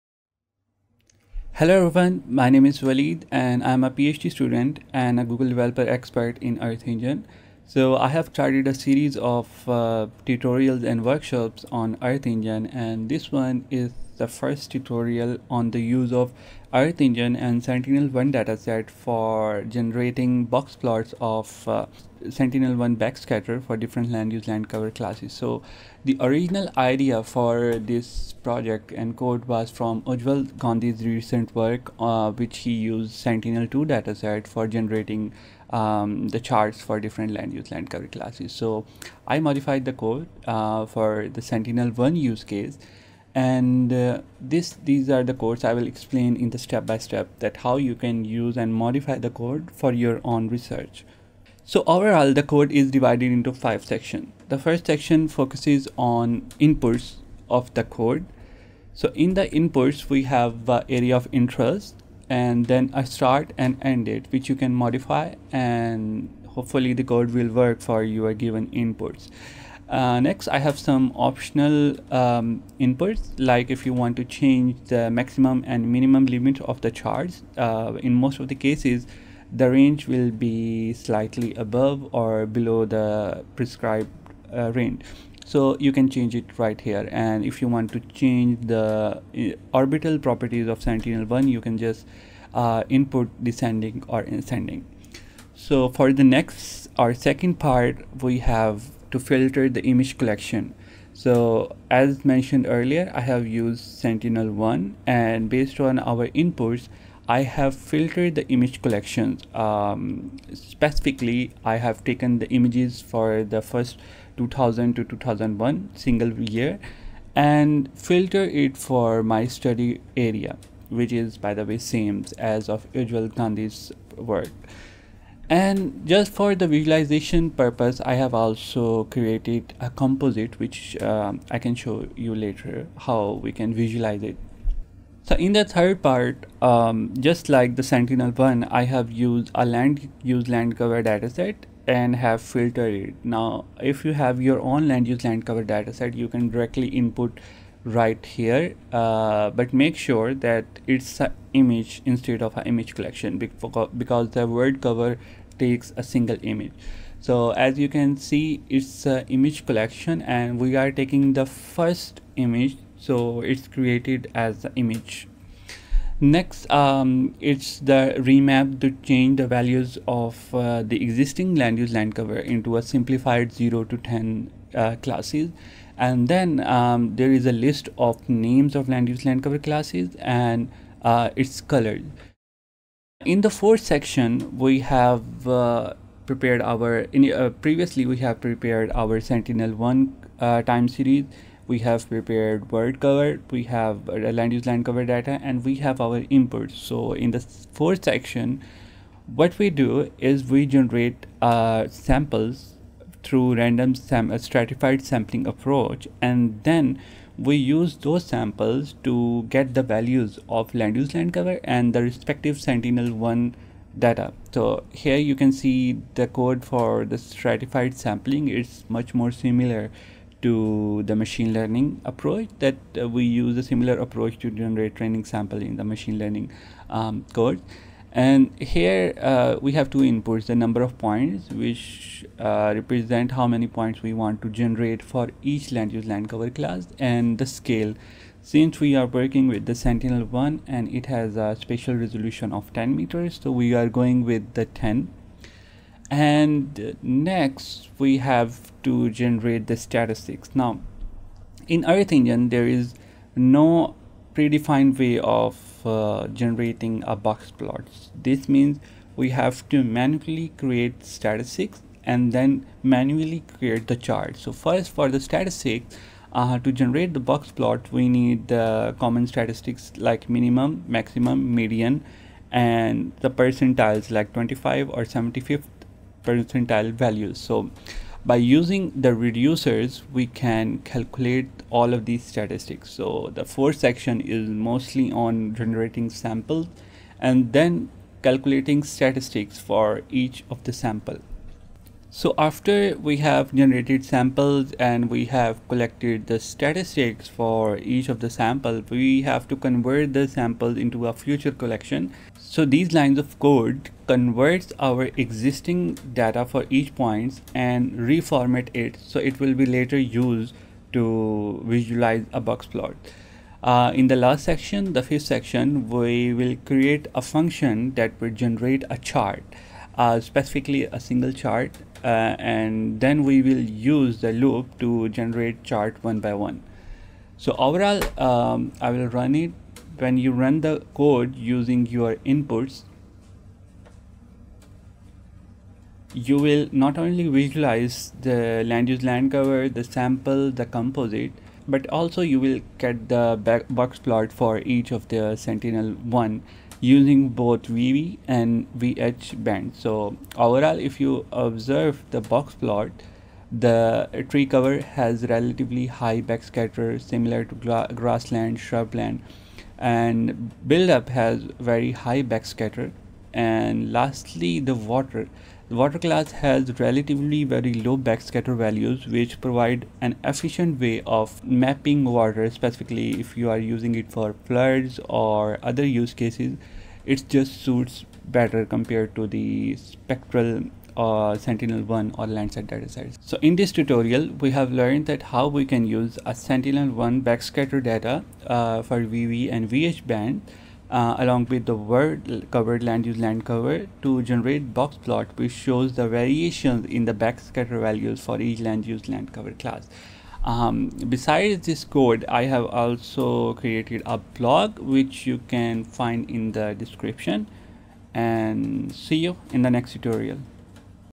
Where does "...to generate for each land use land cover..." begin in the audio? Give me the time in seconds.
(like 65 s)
234 s.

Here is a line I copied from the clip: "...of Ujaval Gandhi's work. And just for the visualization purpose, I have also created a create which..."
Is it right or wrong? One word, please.
wrong.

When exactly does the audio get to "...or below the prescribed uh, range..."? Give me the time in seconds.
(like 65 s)
82 s.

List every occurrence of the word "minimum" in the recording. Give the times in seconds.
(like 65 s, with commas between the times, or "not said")
75 s, 270 s.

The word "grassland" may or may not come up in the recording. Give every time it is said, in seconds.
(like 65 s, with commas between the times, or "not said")
357 s.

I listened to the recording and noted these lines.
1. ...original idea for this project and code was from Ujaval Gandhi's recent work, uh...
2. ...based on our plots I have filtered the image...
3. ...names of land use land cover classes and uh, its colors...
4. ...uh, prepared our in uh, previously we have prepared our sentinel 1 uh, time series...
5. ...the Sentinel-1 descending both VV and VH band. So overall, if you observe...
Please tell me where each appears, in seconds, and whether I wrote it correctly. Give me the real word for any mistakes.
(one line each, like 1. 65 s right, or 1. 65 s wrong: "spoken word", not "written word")
1. 26 s right
2. 105 s wrong: "inputs", not "plots"
3. 178 s right
4. 185 s right
5. 345 s wrong: "using", not "descending".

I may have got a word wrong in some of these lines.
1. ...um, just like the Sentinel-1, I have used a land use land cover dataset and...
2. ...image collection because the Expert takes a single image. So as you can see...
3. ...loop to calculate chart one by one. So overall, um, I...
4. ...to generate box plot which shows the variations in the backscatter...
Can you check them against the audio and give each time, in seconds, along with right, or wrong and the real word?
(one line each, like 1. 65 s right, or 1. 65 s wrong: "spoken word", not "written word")
1. 136 s right
2. 152 s wrong: "WorldCover", not "Expert"
3. 324 s wrong: "generate", not "calculate"
4. 394 s right.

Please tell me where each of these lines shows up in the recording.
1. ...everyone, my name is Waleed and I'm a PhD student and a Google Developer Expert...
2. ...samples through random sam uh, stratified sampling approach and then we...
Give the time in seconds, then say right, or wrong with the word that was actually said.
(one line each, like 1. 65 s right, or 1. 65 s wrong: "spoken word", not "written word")
1. 1 s right
2. 202 s right.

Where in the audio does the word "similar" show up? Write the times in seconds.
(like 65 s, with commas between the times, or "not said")
219 s, 223 s, 357 s.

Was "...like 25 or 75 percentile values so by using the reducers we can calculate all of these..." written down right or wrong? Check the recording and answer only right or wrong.
right.